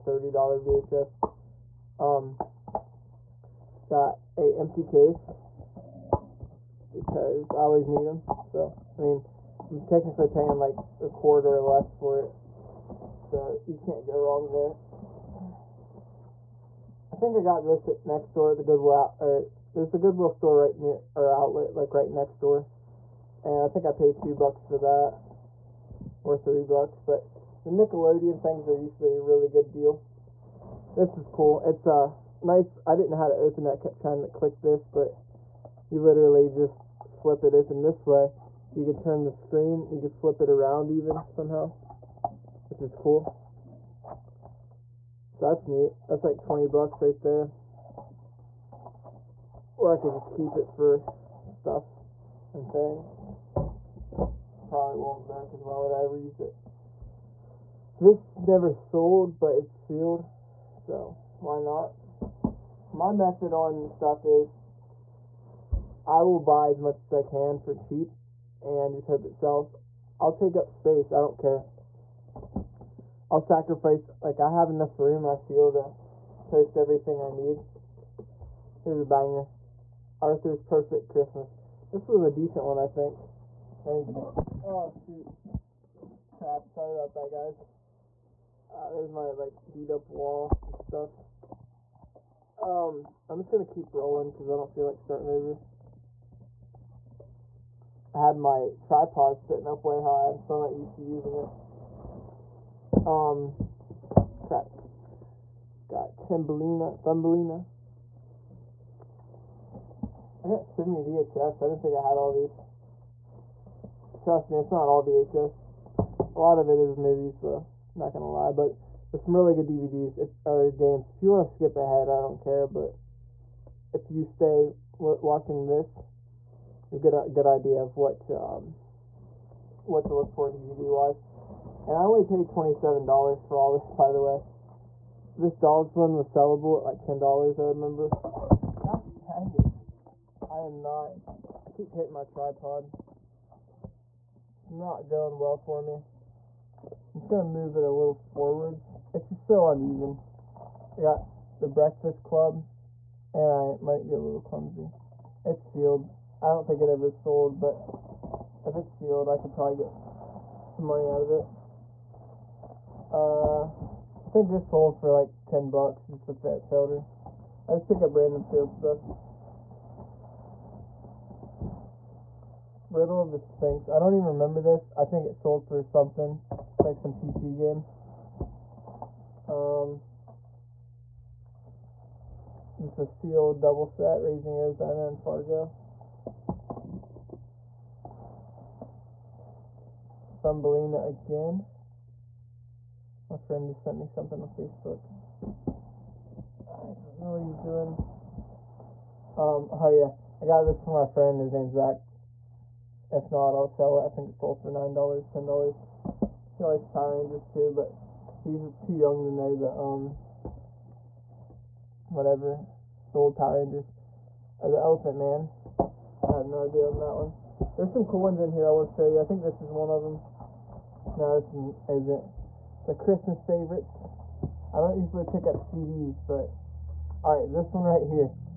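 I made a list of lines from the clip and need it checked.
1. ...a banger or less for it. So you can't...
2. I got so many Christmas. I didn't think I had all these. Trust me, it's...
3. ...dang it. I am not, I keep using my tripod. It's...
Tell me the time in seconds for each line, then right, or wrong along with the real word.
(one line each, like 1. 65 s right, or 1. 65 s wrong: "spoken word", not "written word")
1. 11 s wrong: "quarter", not "banger"
2. 110 s wrong: "VHS", not "Christmas"
3. 139 s wrong: "hitting", not "using".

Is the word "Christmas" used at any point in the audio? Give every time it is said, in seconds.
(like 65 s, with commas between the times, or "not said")
81 s, 222 s.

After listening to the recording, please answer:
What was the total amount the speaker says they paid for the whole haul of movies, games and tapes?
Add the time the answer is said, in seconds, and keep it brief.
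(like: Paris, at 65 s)
$27, at 132 s.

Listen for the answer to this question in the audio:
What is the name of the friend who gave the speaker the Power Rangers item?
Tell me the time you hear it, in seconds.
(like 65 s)
201 s.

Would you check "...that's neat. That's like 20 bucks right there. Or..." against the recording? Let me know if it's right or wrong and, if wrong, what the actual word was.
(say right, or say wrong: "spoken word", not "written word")
right.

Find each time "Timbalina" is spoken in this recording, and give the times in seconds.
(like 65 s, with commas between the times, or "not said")
106 s.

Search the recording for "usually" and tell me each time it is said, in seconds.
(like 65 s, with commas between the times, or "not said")
28 s, 224 s.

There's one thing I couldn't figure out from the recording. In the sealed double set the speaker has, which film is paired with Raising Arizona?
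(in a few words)
Fargo.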